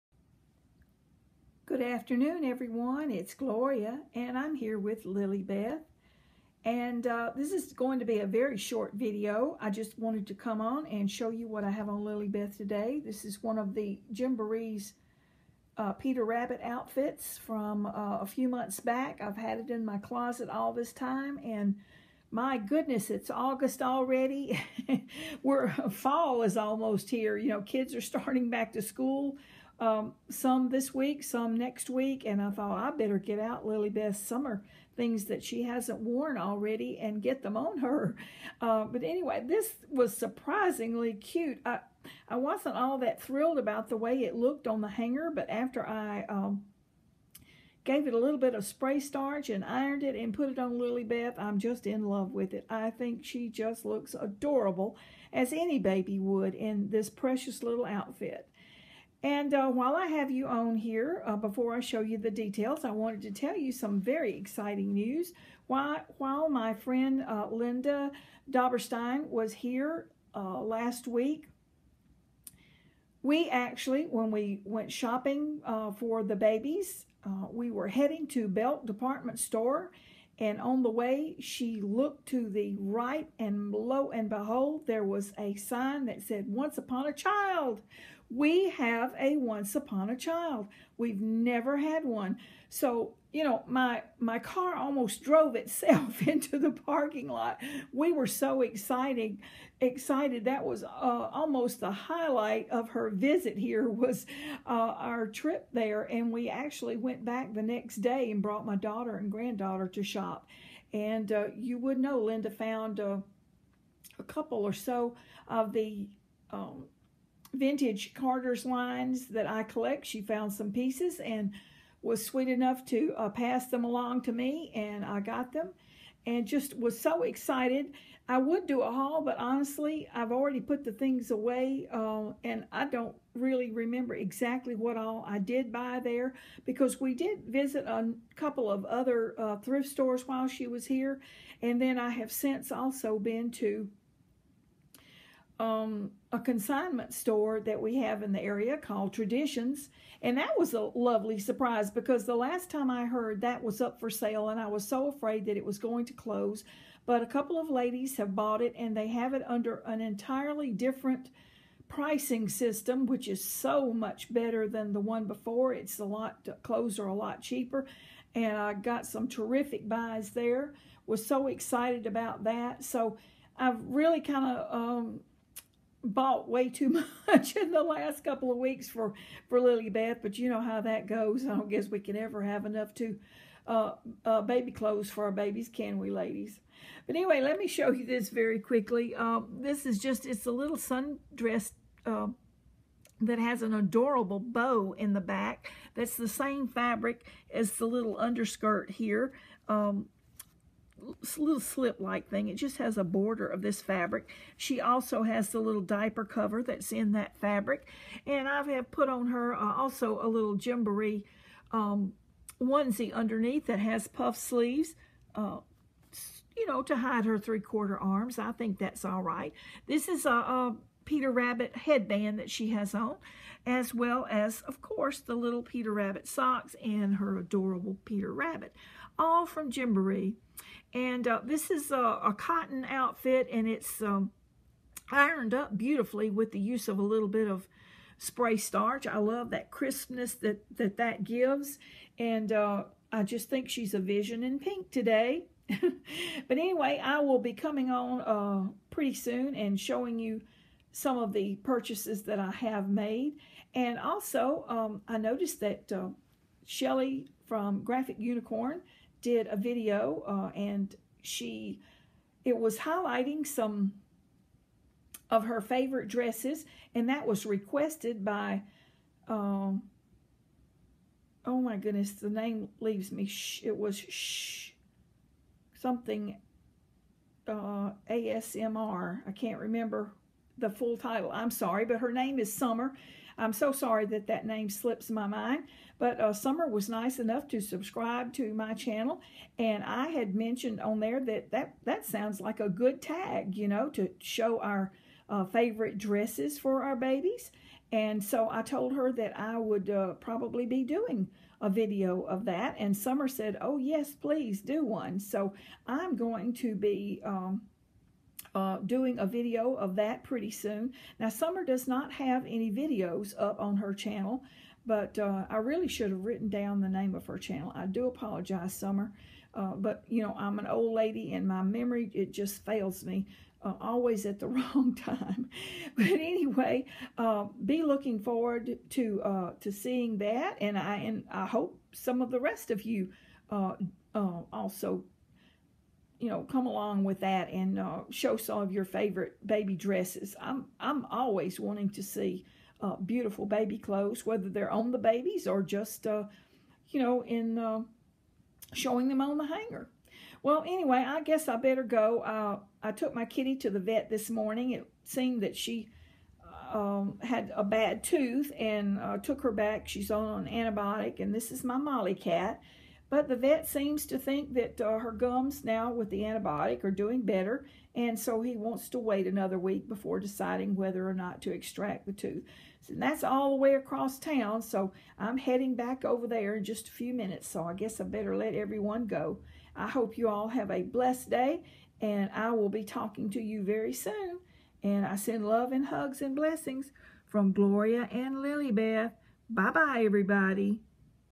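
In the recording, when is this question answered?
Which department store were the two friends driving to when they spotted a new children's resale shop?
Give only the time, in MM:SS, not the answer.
01:18.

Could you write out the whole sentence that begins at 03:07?
But anyway, let me show you this very quickly.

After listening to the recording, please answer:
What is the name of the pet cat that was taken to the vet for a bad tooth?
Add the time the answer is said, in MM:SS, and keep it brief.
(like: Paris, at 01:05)
Molly, at 06:01.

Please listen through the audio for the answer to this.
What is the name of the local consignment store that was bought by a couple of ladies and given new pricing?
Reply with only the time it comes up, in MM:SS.
02:29.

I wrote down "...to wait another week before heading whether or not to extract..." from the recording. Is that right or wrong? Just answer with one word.
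wrong.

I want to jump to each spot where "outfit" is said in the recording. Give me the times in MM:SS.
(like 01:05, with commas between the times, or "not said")
00:16, 00:57, 03:52.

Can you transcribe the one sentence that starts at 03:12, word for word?
Uh, that has an adorable bow in the back.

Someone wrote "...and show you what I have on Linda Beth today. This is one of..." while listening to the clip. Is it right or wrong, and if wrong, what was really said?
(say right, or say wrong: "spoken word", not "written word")
wrong: "Lillie", not "Linda".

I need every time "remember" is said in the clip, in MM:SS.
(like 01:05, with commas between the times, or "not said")
02:13, 04:39.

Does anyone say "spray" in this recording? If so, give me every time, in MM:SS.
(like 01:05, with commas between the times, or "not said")
00:48, 03:58.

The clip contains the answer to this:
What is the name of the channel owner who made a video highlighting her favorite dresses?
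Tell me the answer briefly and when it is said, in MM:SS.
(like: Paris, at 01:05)
Shelly, at 04:16.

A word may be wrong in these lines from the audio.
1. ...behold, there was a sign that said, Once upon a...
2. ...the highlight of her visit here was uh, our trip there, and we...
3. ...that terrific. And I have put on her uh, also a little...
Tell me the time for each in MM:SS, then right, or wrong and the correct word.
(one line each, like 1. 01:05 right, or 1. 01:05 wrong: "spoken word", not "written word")
1. 01:24 right
2. 01:41 right
3. 03:27 wrong: "fabric", not "terrific".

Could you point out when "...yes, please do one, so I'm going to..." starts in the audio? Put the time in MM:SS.
05:03.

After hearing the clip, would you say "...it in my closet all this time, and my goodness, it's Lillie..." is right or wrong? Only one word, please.
wrong.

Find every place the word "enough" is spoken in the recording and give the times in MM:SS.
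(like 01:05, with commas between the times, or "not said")
02:02, 03:02, 04:47.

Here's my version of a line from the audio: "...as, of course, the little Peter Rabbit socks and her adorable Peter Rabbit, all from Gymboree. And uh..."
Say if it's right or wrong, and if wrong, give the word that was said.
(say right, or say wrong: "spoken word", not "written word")
right.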